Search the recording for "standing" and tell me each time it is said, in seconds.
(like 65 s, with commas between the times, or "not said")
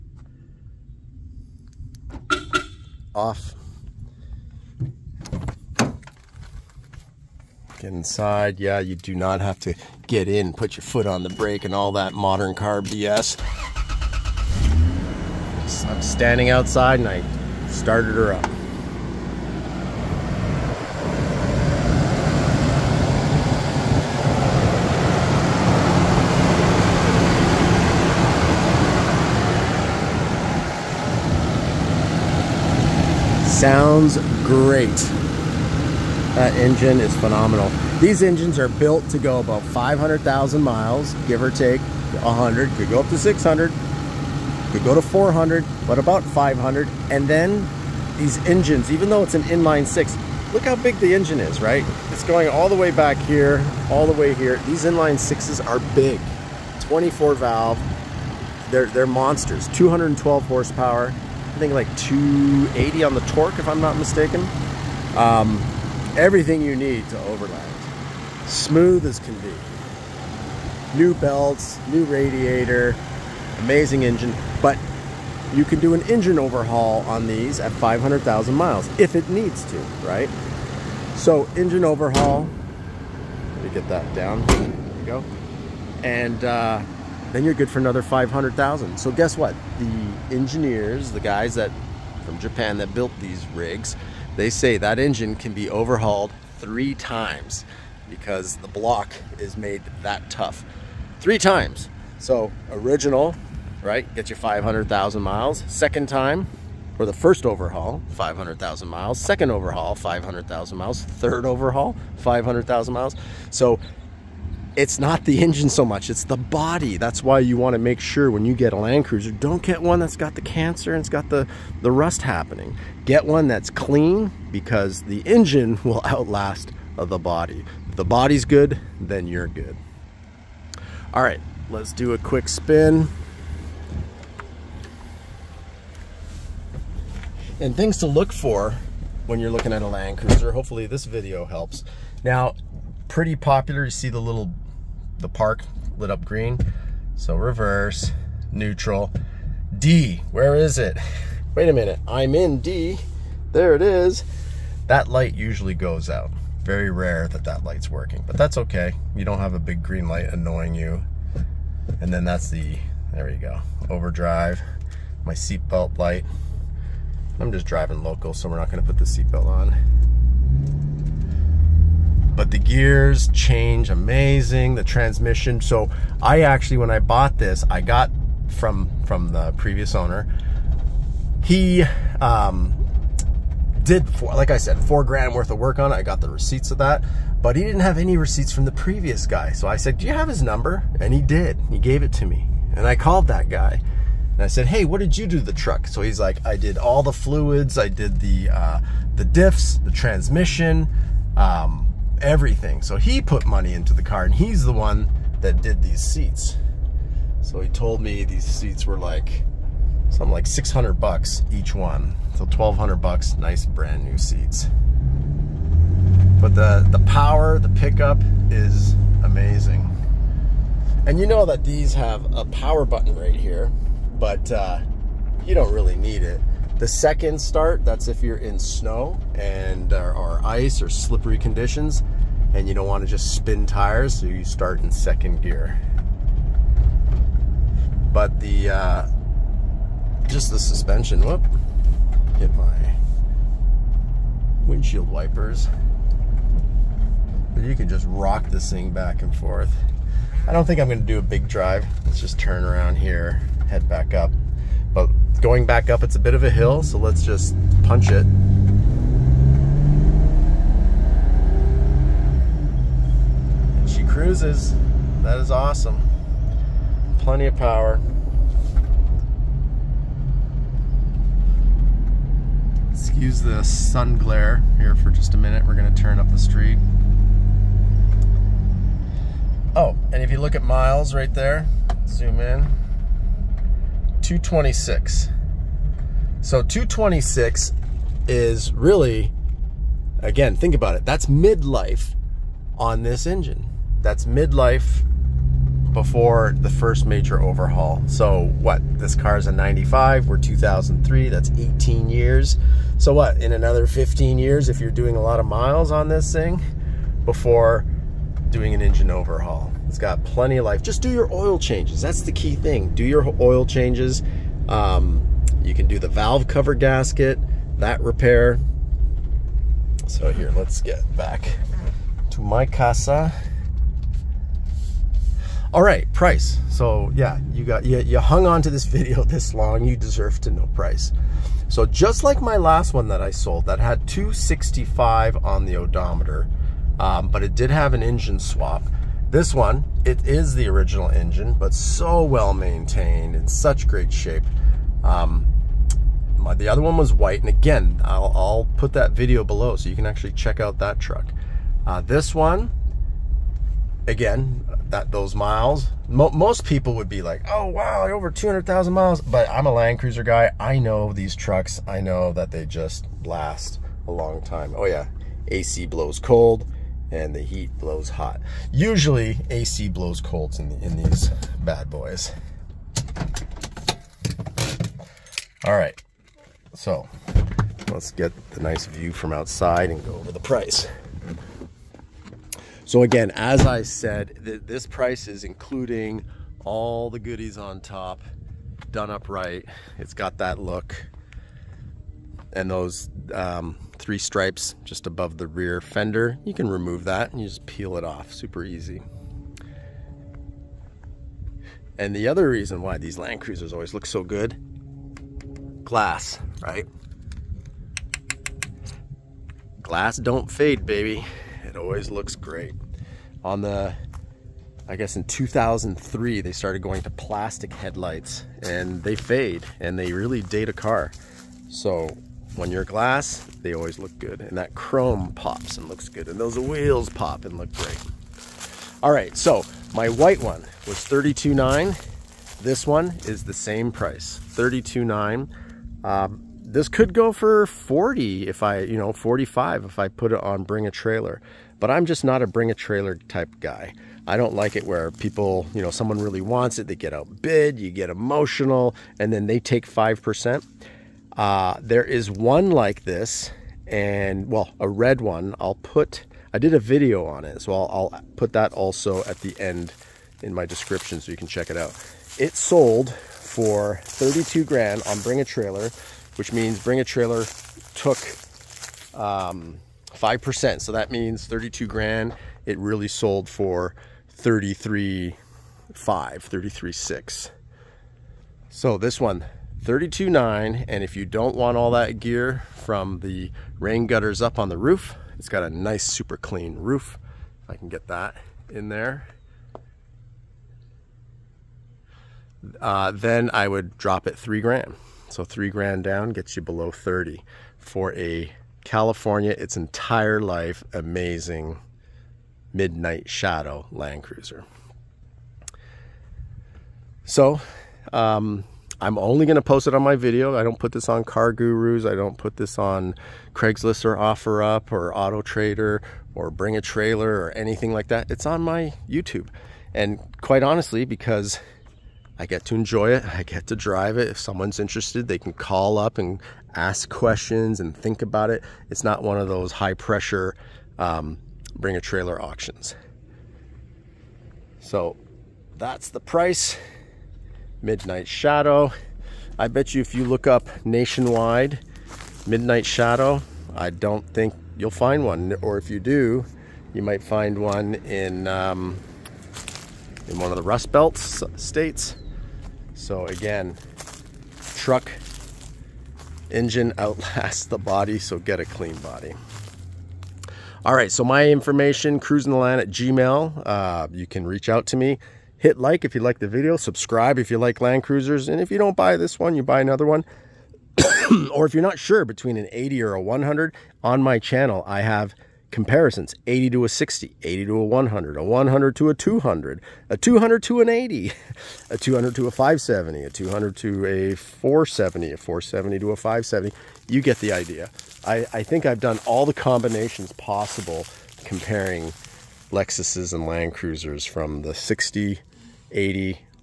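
16 s.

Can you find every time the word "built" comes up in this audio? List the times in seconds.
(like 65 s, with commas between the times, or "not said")
38 s, 92 s.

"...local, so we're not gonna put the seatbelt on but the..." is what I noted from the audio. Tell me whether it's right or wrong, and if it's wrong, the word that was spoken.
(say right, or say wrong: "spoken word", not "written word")
right.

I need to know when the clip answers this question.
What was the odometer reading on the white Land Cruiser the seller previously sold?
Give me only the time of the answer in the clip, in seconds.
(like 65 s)
334 s.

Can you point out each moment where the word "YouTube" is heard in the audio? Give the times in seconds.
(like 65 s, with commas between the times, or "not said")
519 s.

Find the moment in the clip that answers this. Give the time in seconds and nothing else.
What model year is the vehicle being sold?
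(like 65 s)
299 s.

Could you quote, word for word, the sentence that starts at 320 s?
So here, let's get back to my casa.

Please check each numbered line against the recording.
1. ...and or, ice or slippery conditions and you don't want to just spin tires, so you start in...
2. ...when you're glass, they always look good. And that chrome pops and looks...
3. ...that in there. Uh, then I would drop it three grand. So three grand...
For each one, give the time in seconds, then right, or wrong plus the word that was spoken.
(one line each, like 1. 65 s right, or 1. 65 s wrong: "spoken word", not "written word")
1. 229 s right
2. 422 s right
3. 488 s right.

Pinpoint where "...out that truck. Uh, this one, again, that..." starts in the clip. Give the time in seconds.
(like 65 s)
350 s.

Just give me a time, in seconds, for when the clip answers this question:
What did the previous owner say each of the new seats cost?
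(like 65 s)
210 s.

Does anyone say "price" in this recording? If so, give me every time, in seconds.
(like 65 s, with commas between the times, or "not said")
326 s, 330 s, 380 s, 384 s, 433 s, 536 s.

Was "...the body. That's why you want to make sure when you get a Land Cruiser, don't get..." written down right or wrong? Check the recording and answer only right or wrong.
right.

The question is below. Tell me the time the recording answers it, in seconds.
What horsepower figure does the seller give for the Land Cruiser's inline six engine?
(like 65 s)
59 s.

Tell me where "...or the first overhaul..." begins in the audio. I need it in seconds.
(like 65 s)
106 s.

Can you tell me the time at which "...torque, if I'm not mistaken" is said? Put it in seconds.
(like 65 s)
63 s.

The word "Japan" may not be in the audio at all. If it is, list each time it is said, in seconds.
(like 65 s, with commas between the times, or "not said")
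92 s.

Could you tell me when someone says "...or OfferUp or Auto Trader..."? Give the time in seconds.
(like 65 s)
514 s.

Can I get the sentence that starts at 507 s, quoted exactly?
So, um, I'm only going to post it on my video.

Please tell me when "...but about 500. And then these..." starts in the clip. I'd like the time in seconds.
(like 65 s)
45 s.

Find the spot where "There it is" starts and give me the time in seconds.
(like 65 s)
153 s.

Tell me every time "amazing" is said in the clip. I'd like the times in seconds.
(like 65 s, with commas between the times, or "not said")
73 s, 173 s, 219 s, 500 s.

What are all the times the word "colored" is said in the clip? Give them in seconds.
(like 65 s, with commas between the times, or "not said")
not said.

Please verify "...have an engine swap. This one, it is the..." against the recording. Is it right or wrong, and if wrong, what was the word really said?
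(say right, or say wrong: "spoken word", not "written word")
right.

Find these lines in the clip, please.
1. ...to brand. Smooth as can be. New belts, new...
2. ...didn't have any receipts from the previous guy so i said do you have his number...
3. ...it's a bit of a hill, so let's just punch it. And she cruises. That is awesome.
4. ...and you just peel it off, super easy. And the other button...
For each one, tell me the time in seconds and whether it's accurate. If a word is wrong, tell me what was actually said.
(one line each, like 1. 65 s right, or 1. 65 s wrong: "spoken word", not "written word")
1. 67 s wrong: "overland", not "brand"
2. 187 s right
3. 256 s right
4. 397 s wrong: "reason", not "button".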